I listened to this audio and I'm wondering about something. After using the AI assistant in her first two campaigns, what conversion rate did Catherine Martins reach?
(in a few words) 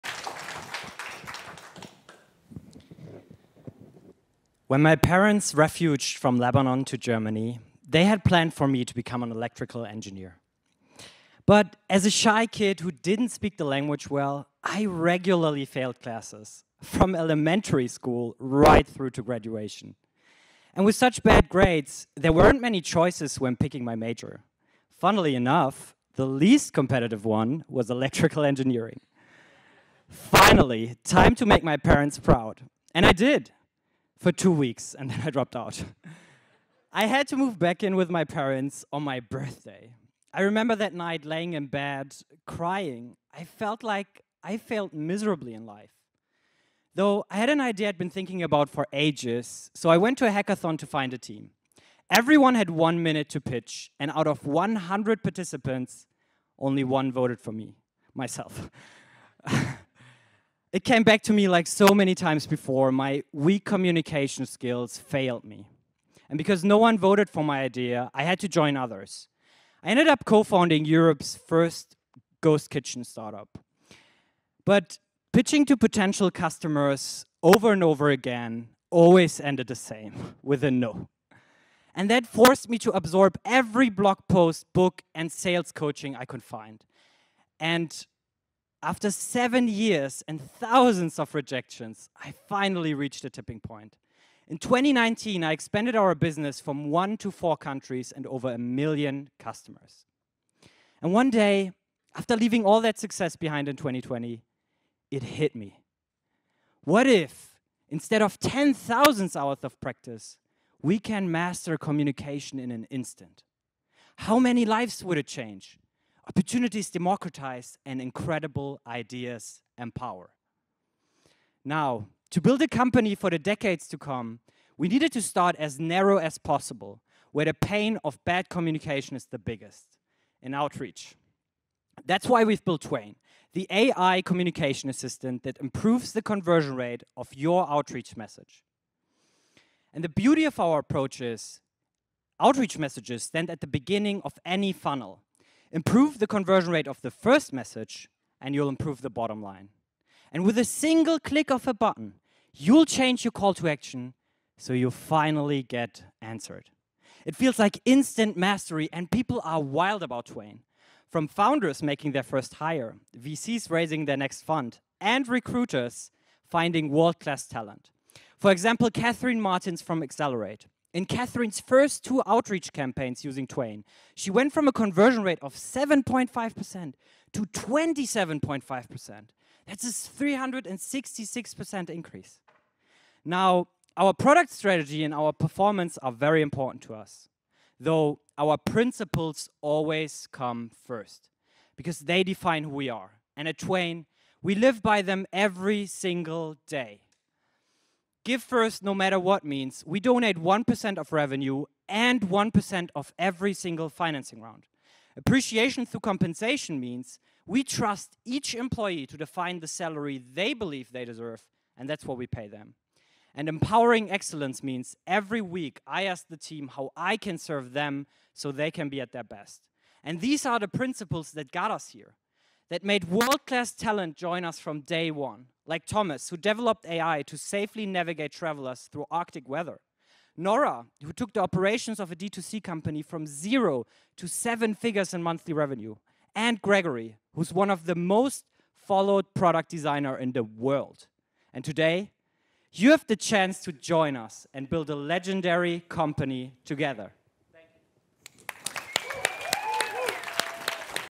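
27.5%.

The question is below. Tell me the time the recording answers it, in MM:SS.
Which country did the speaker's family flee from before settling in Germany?
00:06.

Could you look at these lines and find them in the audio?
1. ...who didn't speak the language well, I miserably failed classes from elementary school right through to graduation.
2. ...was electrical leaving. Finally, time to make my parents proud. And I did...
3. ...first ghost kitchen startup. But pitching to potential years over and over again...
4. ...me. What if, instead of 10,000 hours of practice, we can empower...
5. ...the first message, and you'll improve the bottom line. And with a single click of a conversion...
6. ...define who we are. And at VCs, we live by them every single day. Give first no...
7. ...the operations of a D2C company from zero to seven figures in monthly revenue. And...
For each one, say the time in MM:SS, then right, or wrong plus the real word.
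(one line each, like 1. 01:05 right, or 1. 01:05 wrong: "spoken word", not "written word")
1. 00:12 wrong: "regularly", not "miserably"
2. 00:27 wrong: "engineering", not "leaving"
3. 01:11 wrong: "customers", not "years"
4. 01:45 wrong: "master", not "empower"
5. 02:27 wrong: "button", not "conversion"
6. 03:12 wrong: "Twain", not "VCs"
7. 03:51 right.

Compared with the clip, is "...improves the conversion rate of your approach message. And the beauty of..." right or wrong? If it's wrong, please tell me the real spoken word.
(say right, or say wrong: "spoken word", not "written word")
wrong: "outreach", not "approach".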